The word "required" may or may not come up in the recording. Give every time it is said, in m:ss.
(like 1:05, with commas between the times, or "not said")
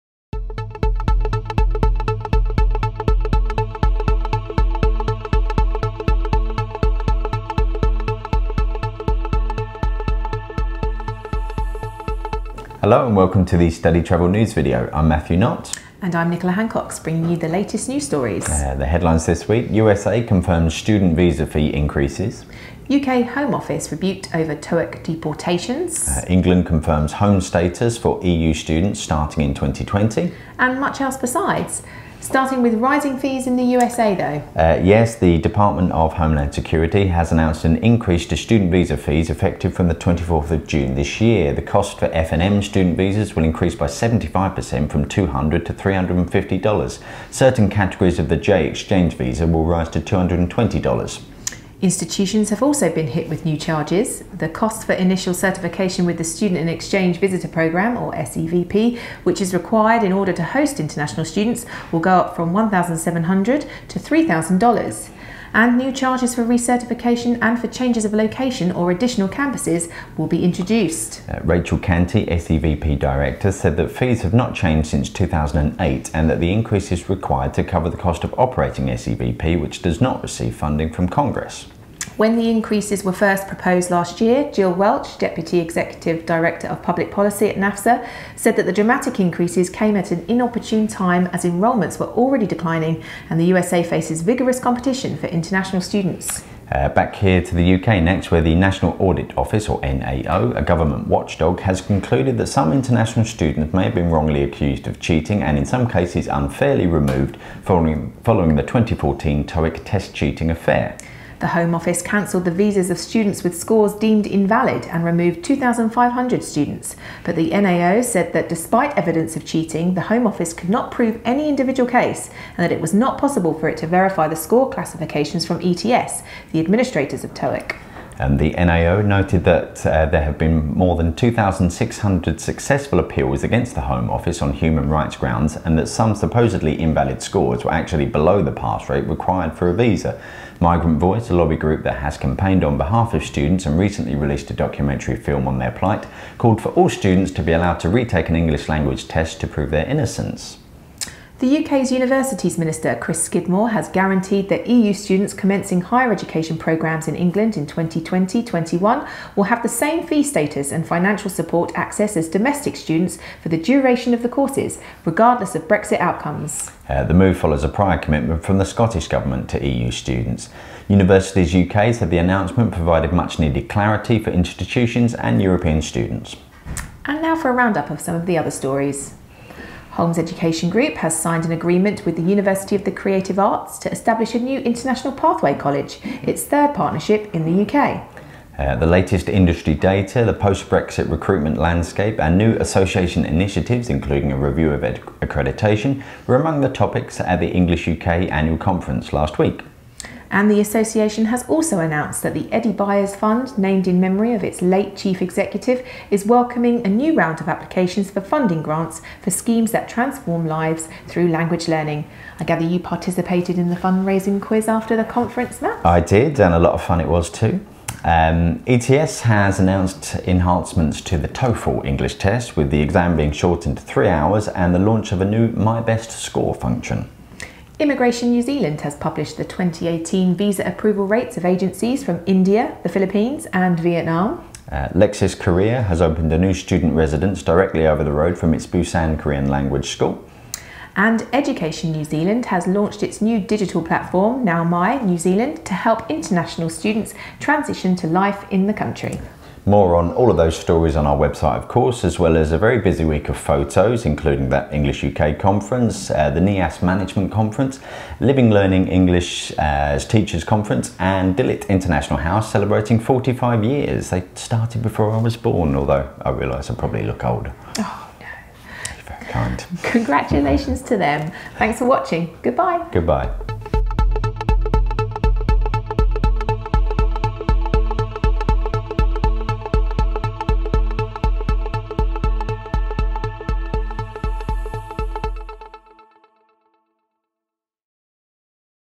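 0:59, 1:17, 2:19.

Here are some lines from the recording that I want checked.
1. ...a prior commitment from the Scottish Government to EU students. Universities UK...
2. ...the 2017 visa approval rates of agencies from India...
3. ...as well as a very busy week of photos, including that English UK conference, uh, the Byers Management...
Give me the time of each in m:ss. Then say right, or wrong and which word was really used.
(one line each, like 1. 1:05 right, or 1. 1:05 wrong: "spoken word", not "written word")
1. 2:47 right
2. 3:49 wrong: "2018", not "2017"
3. 4:12 wrong: "NEAS", not "Byers".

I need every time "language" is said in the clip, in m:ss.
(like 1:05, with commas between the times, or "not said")
2:28, 3:31, 3:59.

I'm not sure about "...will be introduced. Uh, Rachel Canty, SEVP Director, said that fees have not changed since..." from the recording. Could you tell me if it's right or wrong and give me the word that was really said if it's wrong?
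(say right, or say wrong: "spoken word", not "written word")
right.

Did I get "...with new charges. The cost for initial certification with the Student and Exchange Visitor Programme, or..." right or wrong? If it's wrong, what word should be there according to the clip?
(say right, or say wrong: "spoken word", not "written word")
right.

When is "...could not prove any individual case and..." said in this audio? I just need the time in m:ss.
2:00.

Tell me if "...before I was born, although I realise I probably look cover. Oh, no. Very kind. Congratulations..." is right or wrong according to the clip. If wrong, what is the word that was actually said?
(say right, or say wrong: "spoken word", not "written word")
wrong: "older", not "cover".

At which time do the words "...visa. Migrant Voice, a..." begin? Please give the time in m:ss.
2:19.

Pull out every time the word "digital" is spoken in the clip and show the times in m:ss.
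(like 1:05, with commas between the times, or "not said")
4:03.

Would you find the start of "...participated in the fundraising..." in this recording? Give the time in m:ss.
3:32.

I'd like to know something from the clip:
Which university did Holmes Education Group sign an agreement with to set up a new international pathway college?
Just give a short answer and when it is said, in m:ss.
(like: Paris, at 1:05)
University of the Creative Arts, at 3:02.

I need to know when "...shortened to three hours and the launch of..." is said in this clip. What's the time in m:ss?
3:43.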